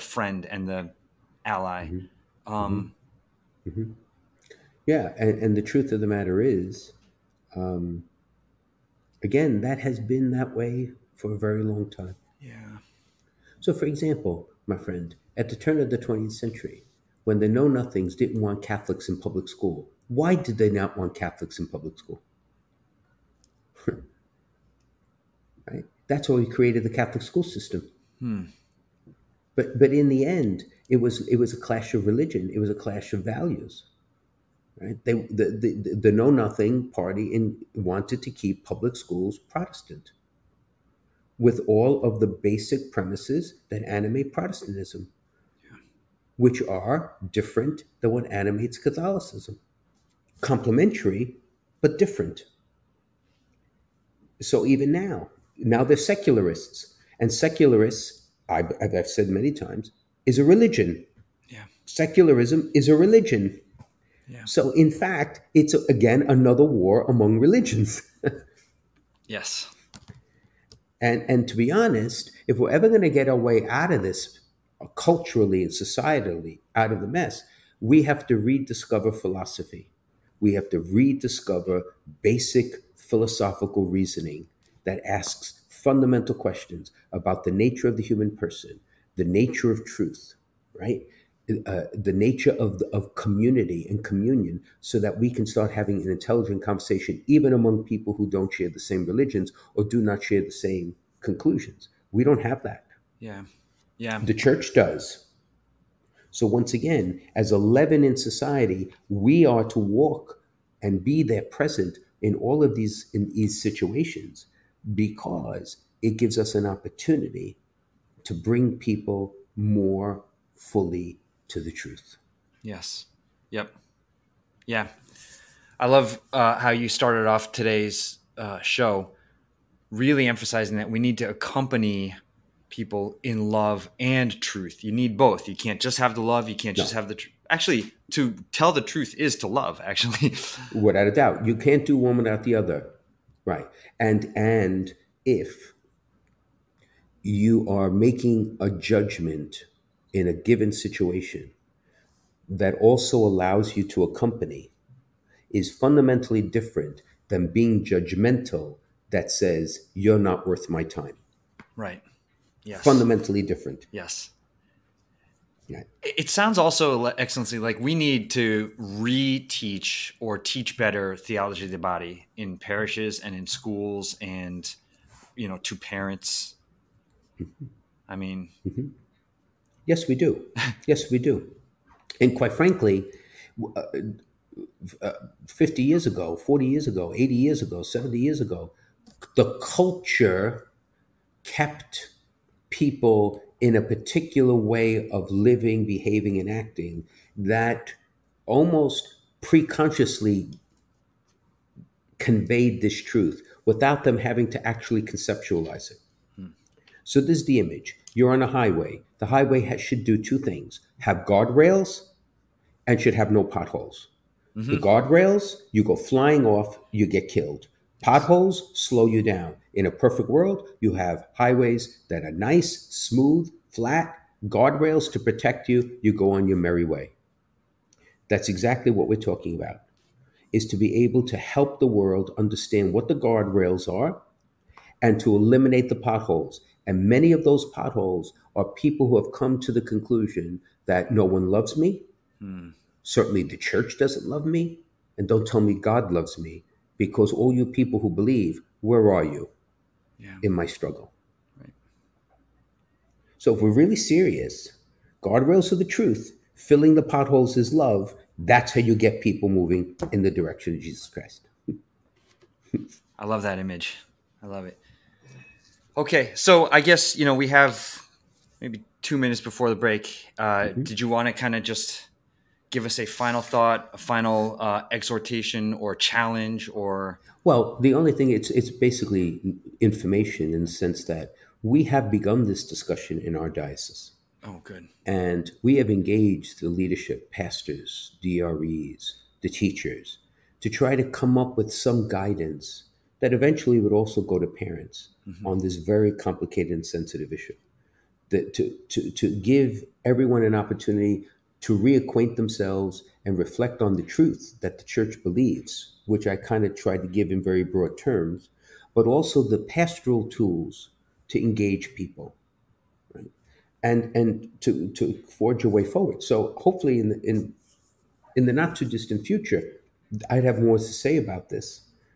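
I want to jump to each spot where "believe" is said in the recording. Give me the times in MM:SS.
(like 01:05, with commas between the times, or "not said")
04:08, 05:05.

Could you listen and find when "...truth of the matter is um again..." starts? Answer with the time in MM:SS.
00:05.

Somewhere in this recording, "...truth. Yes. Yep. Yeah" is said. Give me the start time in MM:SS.
02:01.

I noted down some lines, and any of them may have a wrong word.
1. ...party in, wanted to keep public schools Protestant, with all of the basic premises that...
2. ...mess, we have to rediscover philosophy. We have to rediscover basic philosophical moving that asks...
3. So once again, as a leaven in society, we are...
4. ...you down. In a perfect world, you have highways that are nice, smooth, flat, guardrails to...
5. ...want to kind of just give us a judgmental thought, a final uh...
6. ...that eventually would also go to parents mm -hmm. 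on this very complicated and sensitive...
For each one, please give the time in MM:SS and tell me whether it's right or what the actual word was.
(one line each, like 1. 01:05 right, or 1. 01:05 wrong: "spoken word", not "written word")
1. 00:36 right
2. 01:17 wrong: "reasoning", not "moving"
3. 01:46 right
4. 03:39 right
5. 04:31 wrong: "final", not "judgmental"
6. 04:53 right.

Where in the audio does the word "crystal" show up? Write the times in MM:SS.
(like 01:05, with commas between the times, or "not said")
not said.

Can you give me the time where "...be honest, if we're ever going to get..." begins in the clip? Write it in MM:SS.
01:11.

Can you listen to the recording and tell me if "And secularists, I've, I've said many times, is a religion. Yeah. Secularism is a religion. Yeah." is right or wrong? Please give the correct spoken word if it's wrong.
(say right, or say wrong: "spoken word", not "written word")
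right.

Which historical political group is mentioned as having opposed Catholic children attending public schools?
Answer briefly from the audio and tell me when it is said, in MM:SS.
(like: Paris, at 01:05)
Know Nothing Party, at 00:17.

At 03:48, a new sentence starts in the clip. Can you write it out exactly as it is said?
That's exactly what we're talking about.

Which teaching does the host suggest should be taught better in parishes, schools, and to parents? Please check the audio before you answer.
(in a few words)
Theology of the body.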